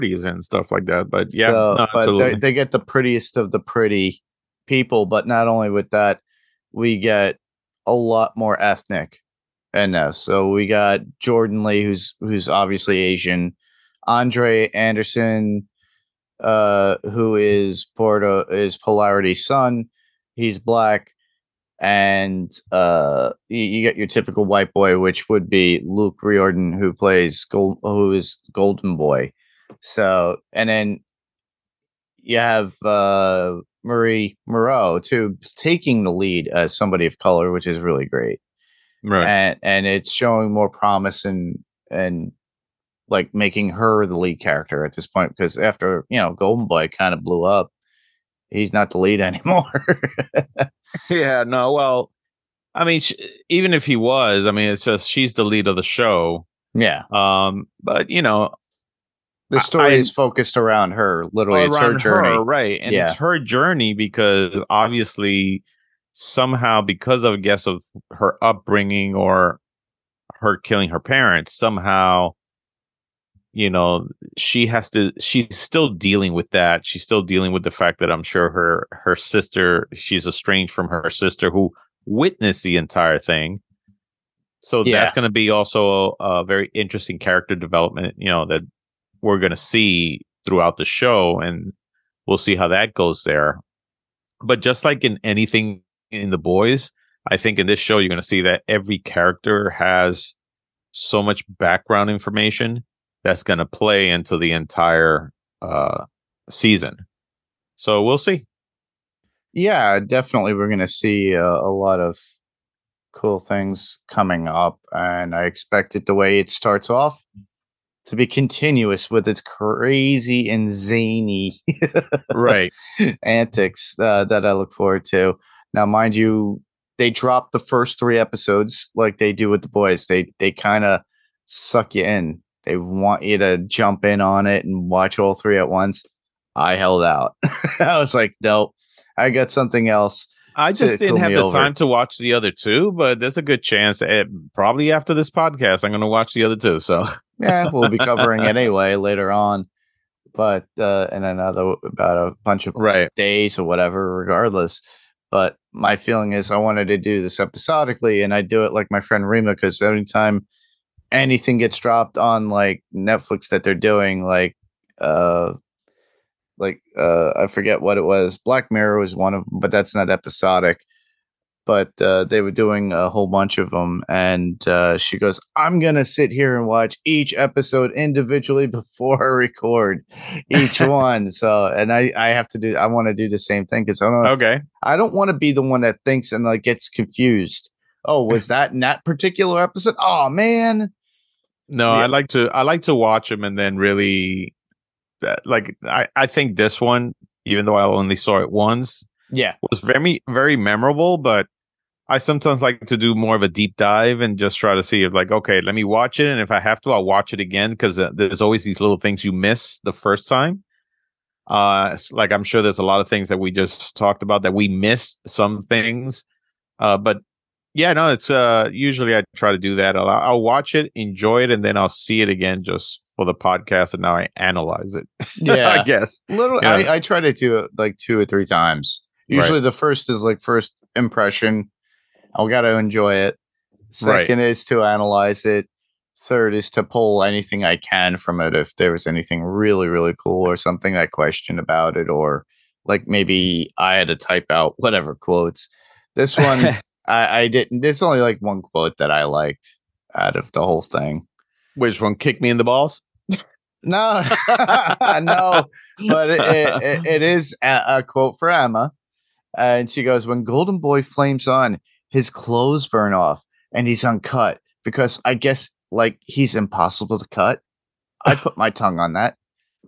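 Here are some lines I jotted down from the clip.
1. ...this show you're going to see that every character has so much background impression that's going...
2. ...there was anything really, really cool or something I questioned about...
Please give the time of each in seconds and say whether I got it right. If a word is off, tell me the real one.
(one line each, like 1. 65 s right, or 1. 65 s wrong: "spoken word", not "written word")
1. 97 s wrong: "information", not "impression"
2. 238 s right.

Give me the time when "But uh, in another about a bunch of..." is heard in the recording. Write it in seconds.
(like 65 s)
150 s.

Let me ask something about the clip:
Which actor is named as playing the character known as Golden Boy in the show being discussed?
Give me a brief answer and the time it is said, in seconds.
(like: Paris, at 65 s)
Luke Riordan, at 25 s.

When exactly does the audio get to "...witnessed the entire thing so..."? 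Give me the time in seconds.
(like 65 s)
82 s.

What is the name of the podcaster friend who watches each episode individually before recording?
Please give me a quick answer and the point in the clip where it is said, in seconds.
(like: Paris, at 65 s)
Rima, at 159 s.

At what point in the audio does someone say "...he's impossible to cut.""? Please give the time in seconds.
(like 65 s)
266 s.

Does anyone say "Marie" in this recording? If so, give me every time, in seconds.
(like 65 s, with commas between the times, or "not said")
33 s.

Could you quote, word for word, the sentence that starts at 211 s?
Uh, like I'm sure there's a lot of things that we just talked about that we missed some things.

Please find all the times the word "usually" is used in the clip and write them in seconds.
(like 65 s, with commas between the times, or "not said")
218 s, 229 s.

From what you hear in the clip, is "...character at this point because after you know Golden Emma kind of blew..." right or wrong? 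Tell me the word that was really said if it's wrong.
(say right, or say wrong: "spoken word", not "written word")
wrong: "Boy", not "Emma".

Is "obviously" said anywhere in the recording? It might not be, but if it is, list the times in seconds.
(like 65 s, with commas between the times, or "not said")
12 s, 64 s.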